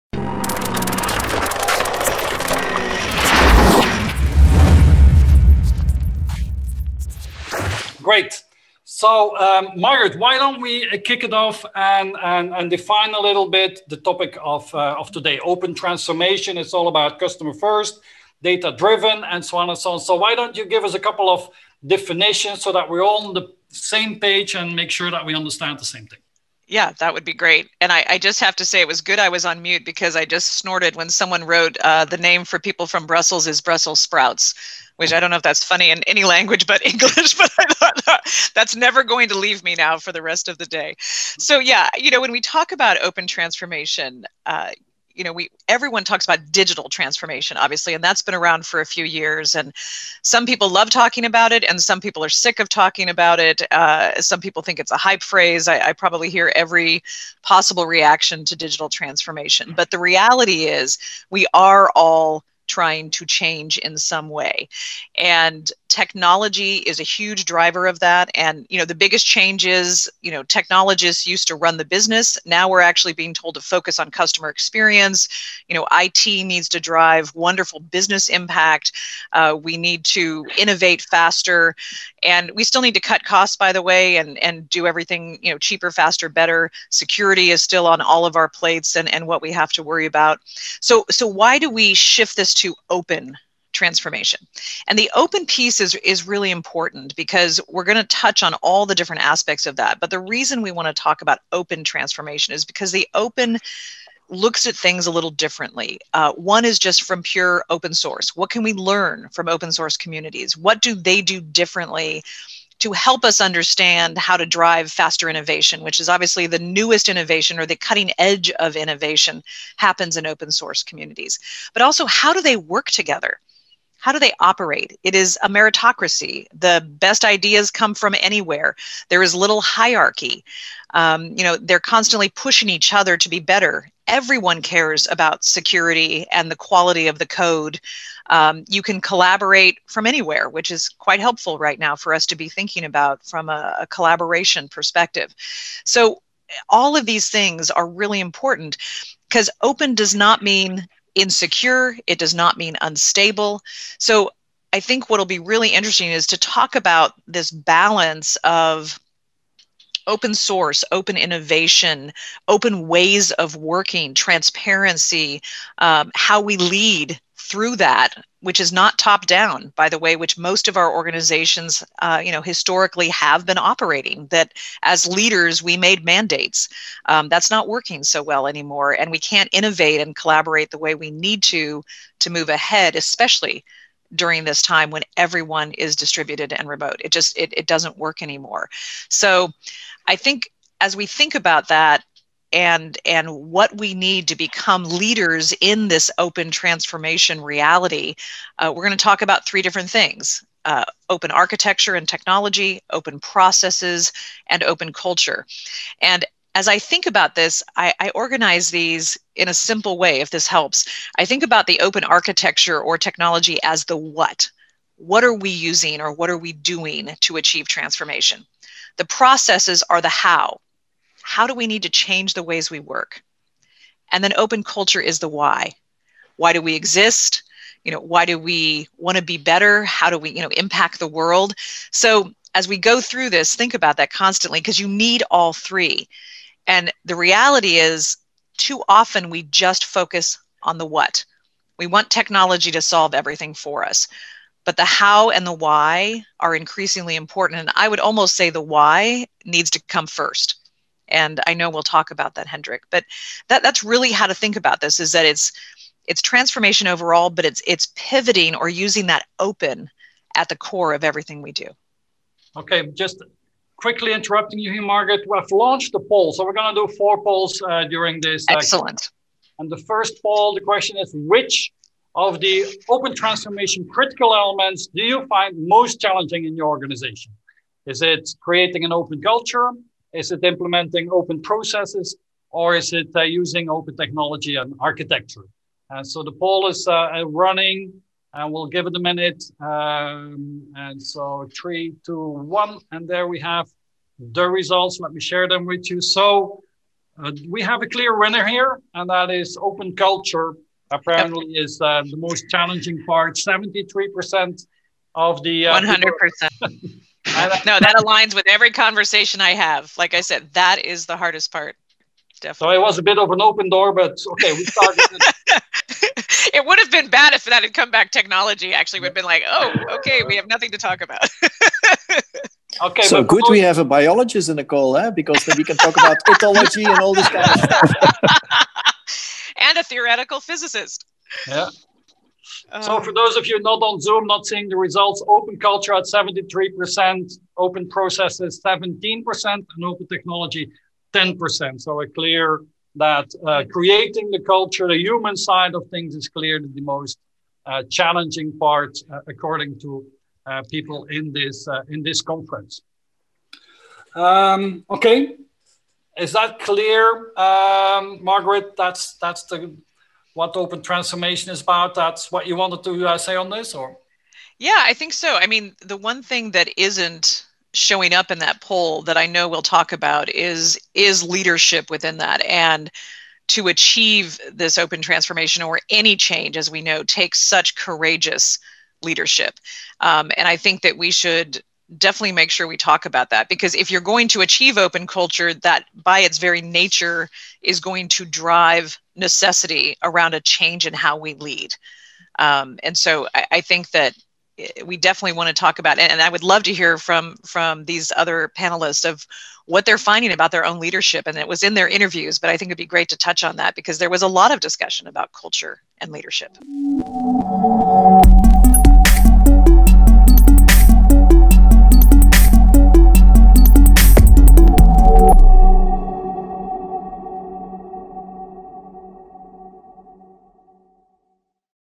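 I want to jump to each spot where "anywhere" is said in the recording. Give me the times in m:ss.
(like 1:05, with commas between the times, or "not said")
2:08, 2:20.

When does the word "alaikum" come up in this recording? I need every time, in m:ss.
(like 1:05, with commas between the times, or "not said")
not said.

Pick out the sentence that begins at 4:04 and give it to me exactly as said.
But the how and the why are increasingly important.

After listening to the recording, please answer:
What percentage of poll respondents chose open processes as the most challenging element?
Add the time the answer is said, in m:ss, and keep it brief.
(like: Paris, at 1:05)
17%, at 5:38.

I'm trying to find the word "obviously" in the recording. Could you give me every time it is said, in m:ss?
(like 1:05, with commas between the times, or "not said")
0:47, 1:56.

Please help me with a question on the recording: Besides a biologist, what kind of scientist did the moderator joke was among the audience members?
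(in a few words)
theoretical physicist.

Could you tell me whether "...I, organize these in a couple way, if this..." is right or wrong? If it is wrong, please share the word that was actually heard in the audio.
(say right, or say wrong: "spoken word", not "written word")
wrong: "simple", not "couple".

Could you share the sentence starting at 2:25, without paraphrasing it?
So all of these things are really important because open does not mean insecure.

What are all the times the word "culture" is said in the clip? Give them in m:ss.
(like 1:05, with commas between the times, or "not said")
3:24, 3:44, 4:39, 4:59, 5:35, 5:44, 6:25, 6:45.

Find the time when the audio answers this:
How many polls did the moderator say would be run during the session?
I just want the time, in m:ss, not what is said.
4:26.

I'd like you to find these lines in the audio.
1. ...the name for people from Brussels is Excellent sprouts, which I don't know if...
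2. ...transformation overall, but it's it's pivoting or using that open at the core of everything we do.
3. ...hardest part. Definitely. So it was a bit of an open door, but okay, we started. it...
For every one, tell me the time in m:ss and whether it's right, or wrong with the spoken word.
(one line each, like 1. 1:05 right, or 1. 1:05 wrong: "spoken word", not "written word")
1. 0:32 wrong: "Brussels", not "Excellent"
2. 4:16 right
3. 5:11 right.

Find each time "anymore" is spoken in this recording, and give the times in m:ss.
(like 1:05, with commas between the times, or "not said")
2:58, 3:08.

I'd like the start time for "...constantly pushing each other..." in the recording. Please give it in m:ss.
2:11.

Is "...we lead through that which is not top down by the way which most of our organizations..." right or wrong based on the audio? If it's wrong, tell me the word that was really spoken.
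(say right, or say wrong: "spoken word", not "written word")
right.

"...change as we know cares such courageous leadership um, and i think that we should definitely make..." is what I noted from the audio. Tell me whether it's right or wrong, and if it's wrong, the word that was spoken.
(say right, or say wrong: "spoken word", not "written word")
wrong: "takes", not "cares".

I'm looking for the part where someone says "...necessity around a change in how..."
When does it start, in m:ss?
6:29.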